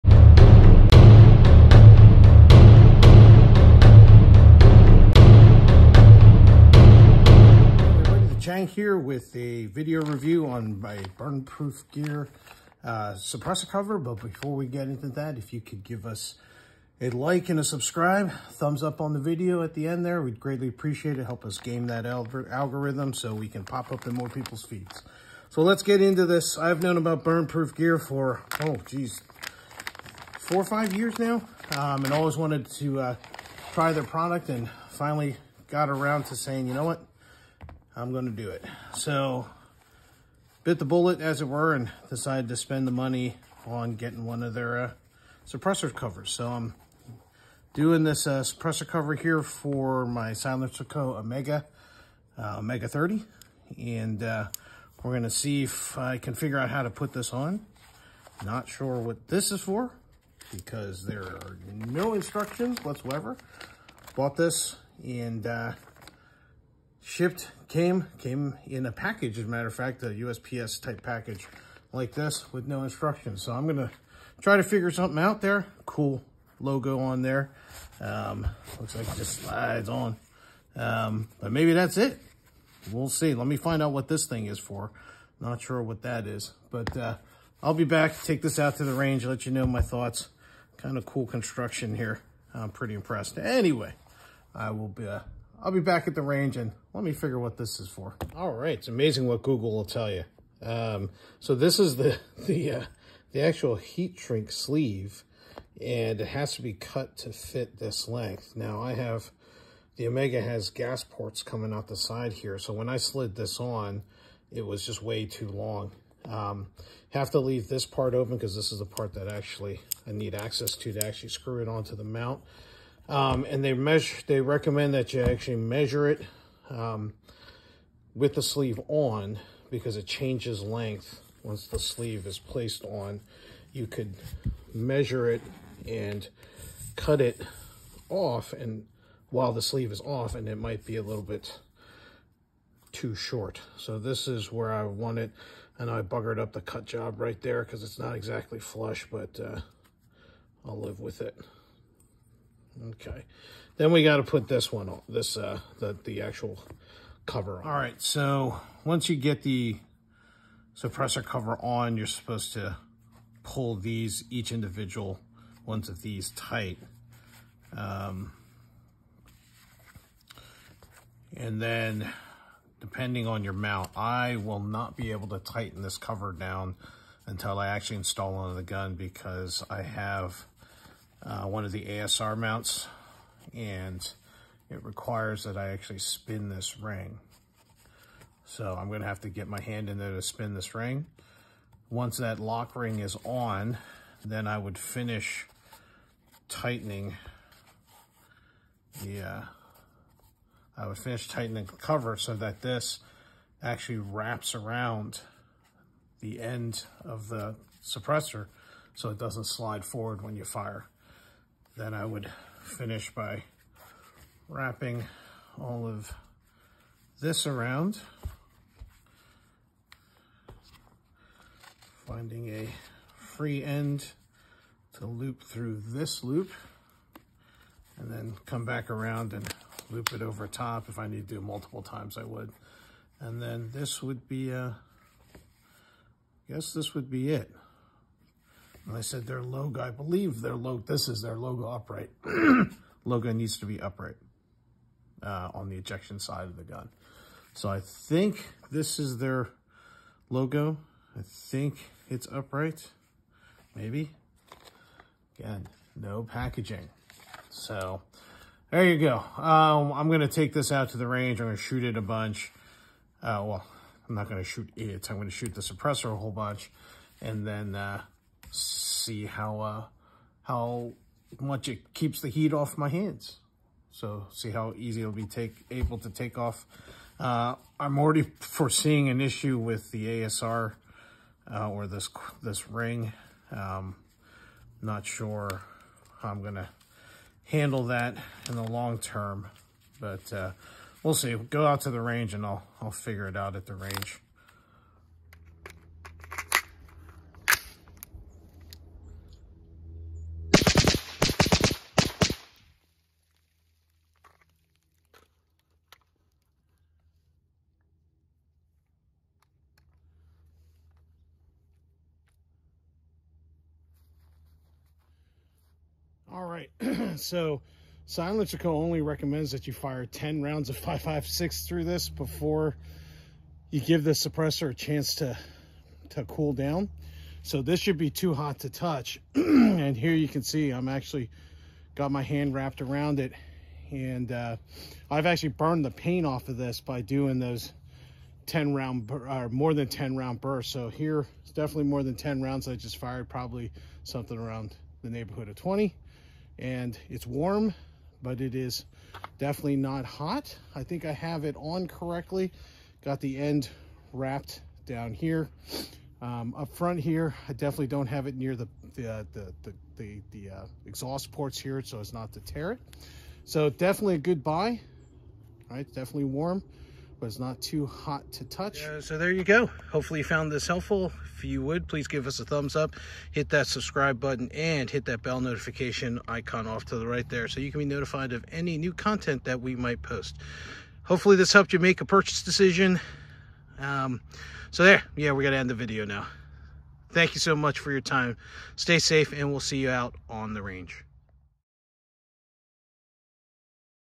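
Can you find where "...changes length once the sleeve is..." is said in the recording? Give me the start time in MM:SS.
02:10.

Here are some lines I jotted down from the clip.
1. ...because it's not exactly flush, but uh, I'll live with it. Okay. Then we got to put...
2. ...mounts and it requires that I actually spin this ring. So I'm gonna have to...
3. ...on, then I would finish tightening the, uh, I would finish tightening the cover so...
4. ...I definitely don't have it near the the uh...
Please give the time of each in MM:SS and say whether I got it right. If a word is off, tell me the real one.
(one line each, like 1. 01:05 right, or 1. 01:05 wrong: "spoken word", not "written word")
1. 02:27 right
2. 03:02 right
3. 03:13 right
4. 05:57 right.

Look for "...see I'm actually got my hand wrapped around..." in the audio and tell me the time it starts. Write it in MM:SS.
05:30.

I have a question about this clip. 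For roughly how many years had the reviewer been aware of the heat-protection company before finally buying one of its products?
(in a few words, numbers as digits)
4 or 5 years.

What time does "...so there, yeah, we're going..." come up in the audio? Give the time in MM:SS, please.
06:24.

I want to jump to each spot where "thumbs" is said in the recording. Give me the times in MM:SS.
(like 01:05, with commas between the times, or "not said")
00:18, 06:12.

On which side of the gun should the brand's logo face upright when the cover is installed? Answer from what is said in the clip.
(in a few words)
ejection side.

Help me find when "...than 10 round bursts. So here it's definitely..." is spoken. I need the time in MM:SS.
05:39.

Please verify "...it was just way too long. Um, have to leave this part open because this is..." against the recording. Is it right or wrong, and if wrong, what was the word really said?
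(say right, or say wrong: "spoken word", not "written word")
right.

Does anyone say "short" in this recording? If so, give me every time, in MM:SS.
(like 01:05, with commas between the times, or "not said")
02:23.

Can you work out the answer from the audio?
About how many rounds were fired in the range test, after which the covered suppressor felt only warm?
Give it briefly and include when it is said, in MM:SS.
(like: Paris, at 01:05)
20, at 05:45.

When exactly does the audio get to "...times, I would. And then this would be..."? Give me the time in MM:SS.
03:51.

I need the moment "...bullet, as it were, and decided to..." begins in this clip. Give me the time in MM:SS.
00:40.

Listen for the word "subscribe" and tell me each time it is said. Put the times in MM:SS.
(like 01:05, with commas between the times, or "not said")
00:17, 06:13.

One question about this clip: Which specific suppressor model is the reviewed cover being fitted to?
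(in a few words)
Omega 30.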